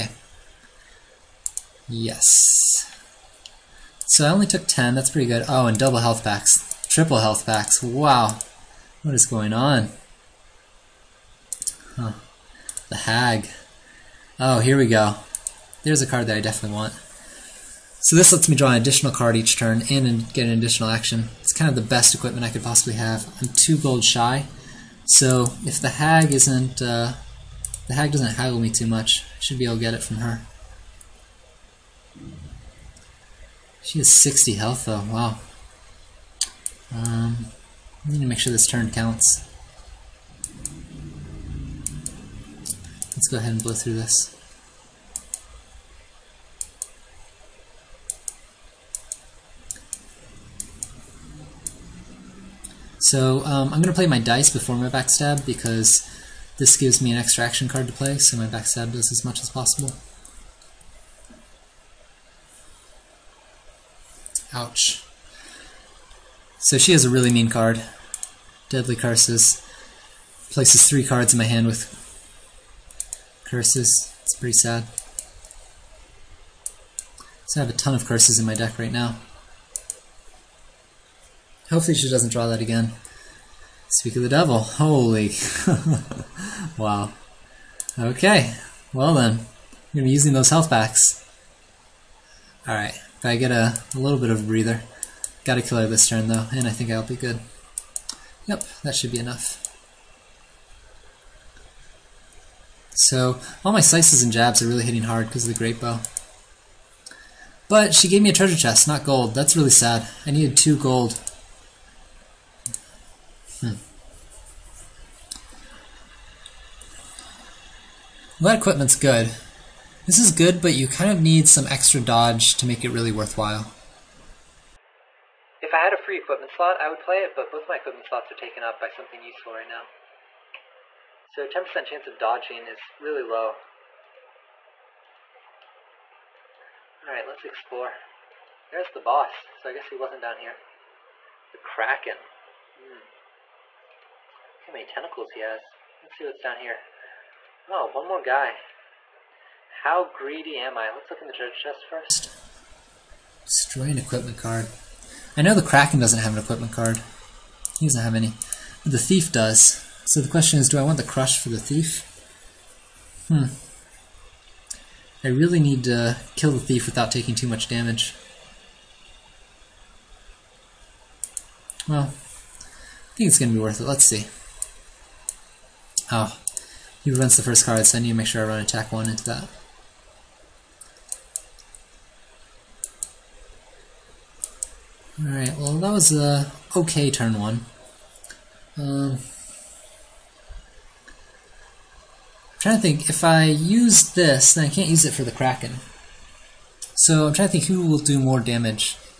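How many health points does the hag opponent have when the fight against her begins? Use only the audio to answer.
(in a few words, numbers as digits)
60.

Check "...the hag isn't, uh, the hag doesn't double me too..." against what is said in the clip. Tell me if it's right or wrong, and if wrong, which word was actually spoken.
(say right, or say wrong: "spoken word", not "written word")
wrong: "haggle", not "double".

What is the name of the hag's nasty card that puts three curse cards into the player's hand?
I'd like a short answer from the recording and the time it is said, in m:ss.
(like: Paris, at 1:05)
Deadly Curses, at 1:08.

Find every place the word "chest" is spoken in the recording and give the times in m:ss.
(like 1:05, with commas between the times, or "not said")
1:48, 2:31.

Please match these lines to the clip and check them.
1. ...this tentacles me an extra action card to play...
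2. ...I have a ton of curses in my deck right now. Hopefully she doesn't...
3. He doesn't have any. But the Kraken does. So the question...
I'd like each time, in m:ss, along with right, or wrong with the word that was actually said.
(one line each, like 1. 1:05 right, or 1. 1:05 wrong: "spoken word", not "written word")
1. 0:56 wrong: "gives", not "tentacles"
2. 1:17 right
3. 2:37 wrong: "Thief", not "Kraken".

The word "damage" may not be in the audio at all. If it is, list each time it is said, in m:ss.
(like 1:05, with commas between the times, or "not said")
2:47, 3:18.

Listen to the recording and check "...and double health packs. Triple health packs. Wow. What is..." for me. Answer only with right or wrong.
right.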